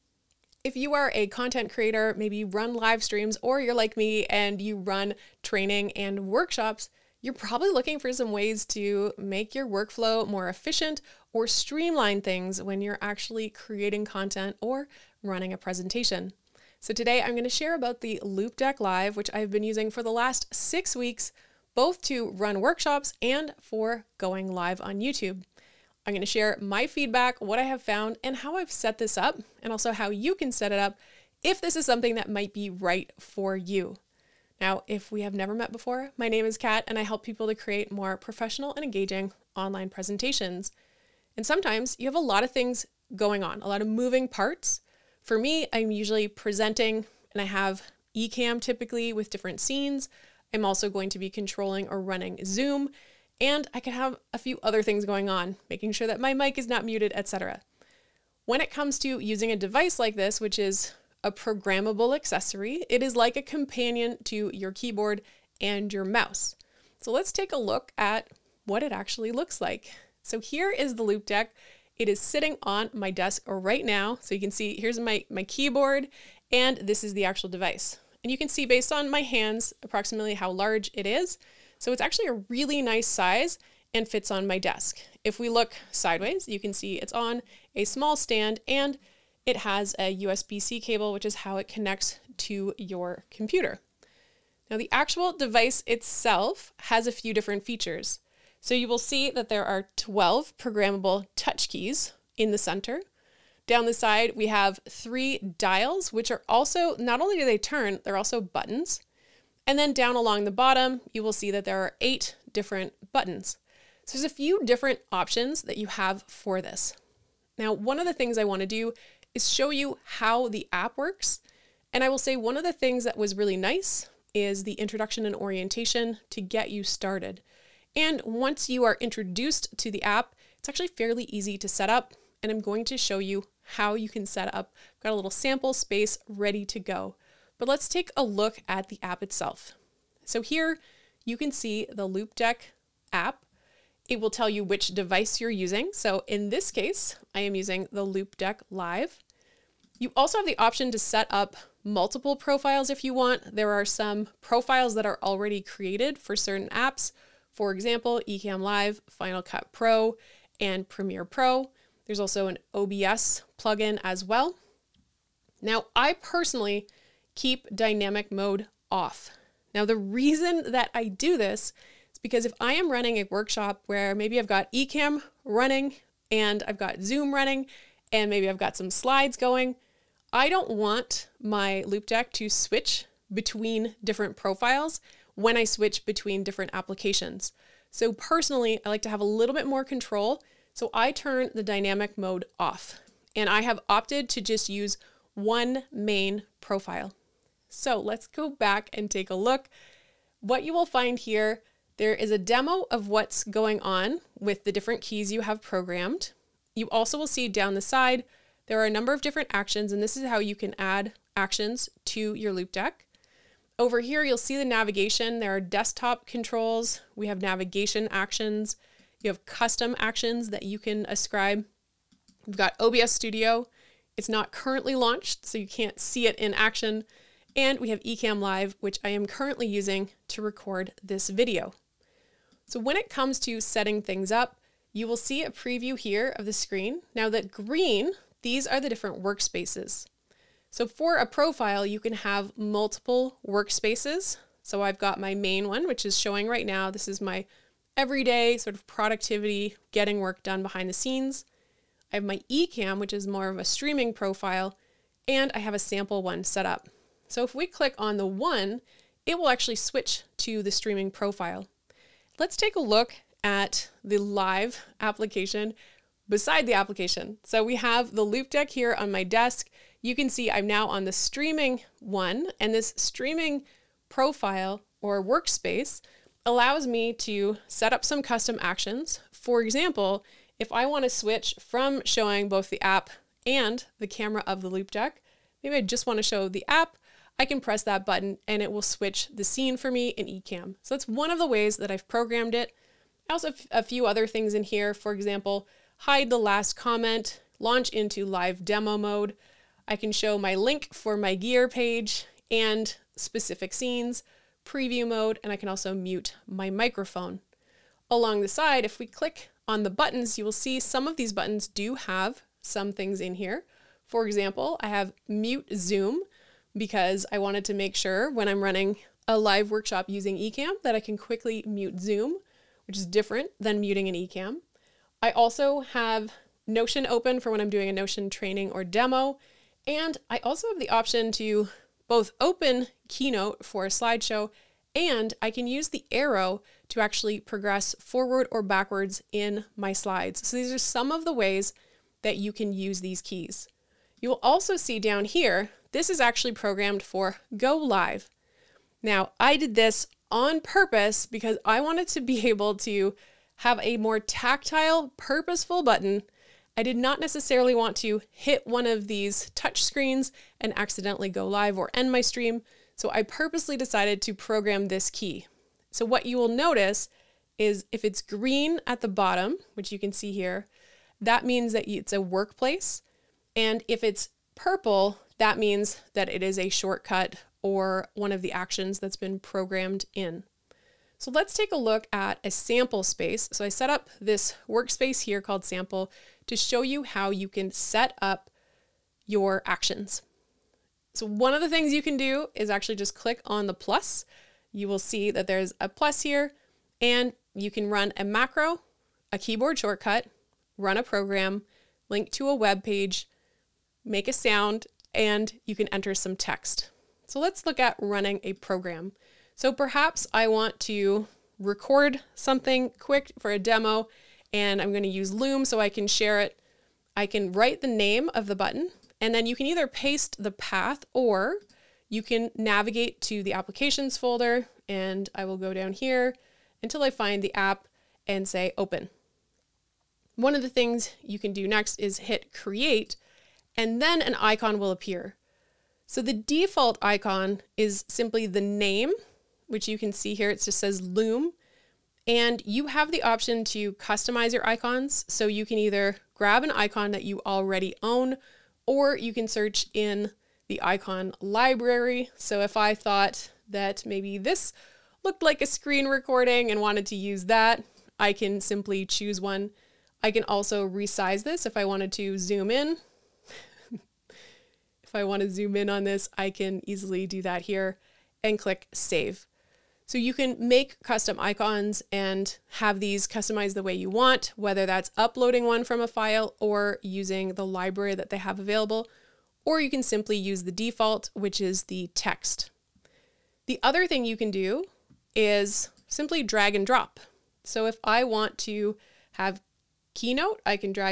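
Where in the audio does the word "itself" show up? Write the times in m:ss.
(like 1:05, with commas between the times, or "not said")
1:35, 2:19.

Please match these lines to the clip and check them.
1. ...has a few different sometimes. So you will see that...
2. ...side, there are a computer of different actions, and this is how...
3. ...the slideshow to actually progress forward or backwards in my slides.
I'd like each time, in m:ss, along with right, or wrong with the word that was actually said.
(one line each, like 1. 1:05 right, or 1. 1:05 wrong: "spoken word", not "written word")
1. 1:36 wrong: "features", not "sometimes"
2. 3:27 wrong: "number", not "computer"
3. 5:35 wrong: "arrow", not "slideshow".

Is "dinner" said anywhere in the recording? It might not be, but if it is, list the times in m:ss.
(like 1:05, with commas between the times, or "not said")
not said.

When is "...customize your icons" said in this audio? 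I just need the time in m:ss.
7:23.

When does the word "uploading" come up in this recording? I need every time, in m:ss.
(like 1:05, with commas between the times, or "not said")
7:55.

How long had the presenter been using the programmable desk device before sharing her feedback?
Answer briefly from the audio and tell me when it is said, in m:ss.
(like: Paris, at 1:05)
6 weeks, at 0:20.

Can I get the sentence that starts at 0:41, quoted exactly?
And sometimes you have a lot of things going on, a lot of moving parts.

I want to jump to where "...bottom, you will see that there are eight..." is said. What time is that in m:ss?
1:50.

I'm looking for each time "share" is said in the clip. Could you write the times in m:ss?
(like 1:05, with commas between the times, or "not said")
0:17, 0:26, 6:56.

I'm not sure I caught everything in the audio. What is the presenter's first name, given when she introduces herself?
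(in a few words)
Cat.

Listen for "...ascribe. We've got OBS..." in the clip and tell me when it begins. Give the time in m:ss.
3:41.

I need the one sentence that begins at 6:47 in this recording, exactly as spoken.
So let's look at running a program.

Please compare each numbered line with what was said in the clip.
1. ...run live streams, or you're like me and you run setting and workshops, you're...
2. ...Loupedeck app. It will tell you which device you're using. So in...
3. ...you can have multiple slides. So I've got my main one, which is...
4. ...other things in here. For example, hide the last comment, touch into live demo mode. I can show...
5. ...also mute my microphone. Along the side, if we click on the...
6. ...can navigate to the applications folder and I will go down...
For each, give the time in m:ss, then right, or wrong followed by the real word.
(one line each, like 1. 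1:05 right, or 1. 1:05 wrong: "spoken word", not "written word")
1. 0:02 wrong: "training", not "setting"
2. 2:22 right
3. 4:01 wrong: "workspaces", not "slides"
4. 4:54 wrong: "launch", not "touch"
5. 5:05 right
6. 7:02 right.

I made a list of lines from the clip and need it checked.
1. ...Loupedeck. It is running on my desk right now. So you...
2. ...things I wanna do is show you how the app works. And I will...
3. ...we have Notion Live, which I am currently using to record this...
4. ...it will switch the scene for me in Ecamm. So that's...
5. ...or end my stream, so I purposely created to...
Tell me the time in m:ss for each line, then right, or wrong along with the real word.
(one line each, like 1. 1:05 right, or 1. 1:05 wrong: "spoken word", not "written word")
1. 1:11 wrong: "sitting", not "running"
2. 1:58 right
3. 3:47 wrong: "Ecamm", not "Notion"
4. 4:48 right
5. 6:01 wrong: "decided", not "created".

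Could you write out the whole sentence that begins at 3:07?
So personally, I like to have a little bit more control.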